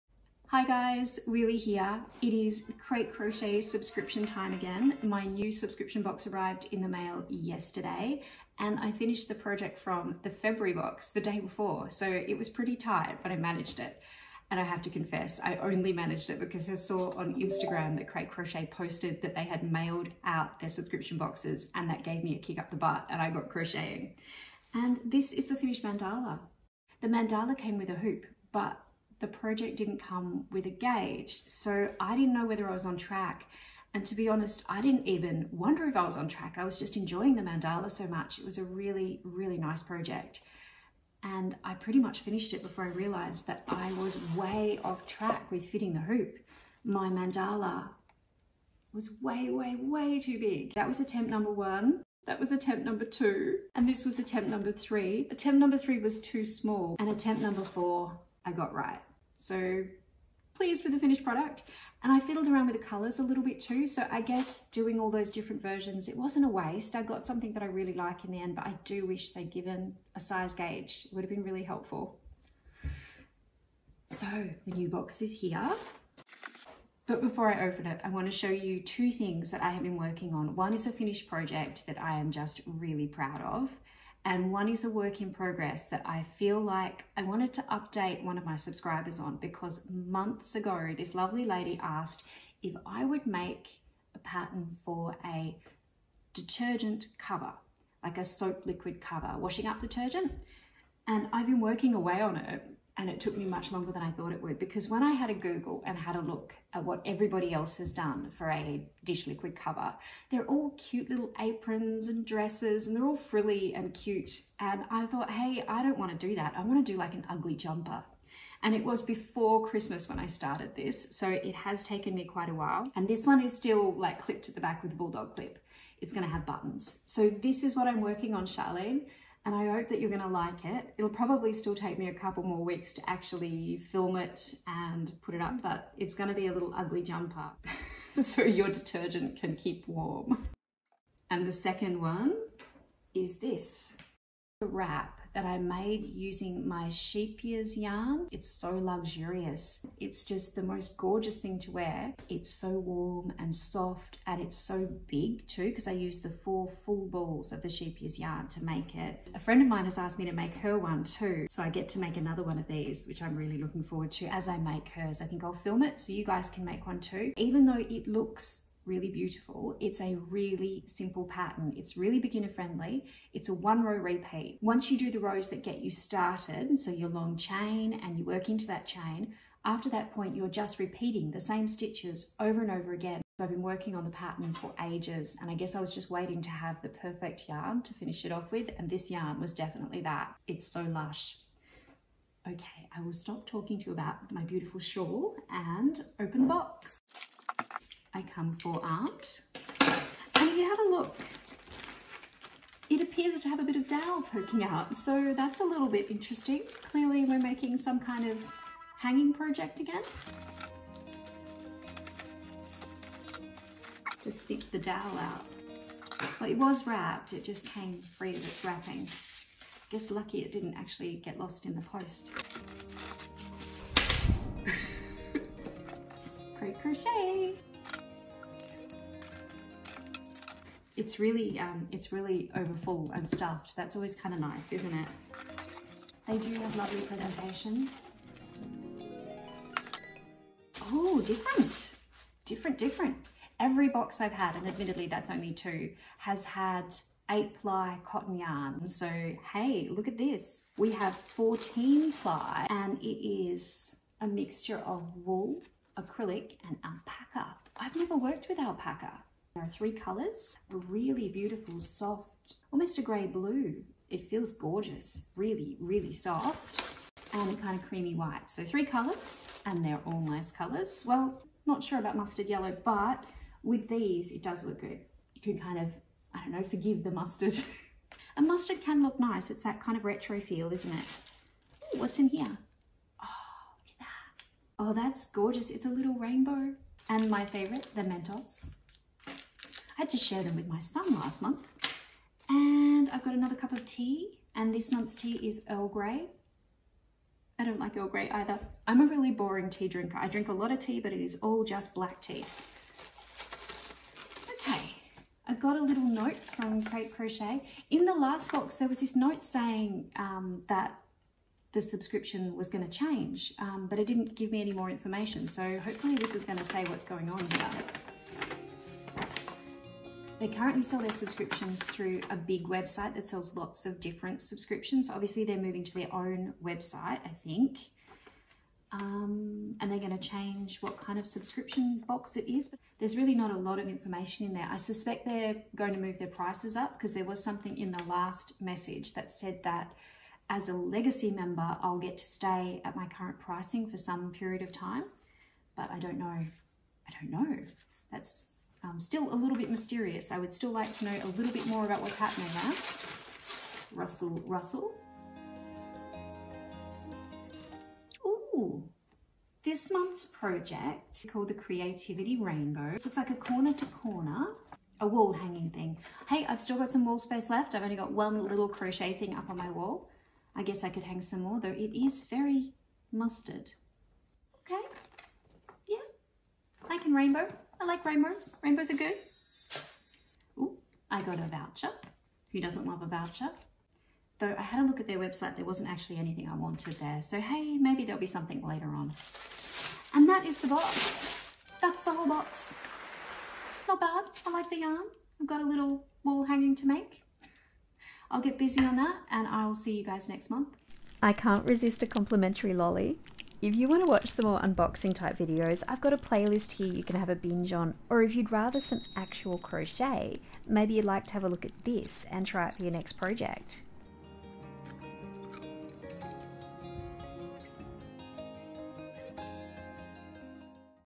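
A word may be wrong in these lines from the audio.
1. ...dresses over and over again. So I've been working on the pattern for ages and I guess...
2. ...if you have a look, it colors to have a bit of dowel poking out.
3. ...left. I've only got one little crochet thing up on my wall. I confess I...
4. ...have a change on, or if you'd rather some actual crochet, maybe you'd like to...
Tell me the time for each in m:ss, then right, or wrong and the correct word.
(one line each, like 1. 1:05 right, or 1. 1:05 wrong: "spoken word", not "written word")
1. 3:01 wrong: "stitches", not "dresses"
2. 3:20 wrong: "appears", not "colors"
3. 6:07 wrong: "guess", not "confess"
4. 6:47 wrong: "binge", not "change".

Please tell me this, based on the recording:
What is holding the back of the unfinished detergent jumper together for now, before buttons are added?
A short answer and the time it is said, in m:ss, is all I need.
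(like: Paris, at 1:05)
A bulldog clip, at 2:04.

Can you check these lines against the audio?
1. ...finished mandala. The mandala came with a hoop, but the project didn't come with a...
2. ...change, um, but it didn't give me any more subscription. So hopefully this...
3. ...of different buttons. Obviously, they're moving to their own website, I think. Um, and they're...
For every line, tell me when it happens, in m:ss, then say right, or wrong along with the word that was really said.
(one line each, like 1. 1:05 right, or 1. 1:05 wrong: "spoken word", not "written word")
1. 0:25 right
2. 5:12 wrong: "information", not "subscription"
3. 5:23 wrong: "subscriptions", not "buttons".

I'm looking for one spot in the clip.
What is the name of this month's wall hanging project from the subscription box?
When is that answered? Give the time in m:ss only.
6:01.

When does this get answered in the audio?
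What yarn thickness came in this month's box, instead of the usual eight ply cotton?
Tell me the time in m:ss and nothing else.
4:11.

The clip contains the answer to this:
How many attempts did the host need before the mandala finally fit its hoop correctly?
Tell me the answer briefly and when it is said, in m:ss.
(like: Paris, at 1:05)
4, at 0:57.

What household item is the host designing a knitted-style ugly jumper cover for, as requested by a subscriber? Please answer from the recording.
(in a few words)
Dish liquid.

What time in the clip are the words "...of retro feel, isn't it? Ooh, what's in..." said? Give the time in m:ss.
4:39.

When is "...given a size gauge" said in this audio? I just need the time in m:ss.
1:09.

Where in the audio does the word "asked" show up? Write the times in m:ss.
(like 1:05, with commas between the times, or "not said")
1:31, 2:39.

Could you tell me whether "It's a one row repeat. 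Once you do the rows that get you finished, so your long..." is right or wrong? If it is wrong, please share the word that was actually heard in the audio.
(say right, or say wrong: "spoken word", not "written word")
wrong: "started", not "finished".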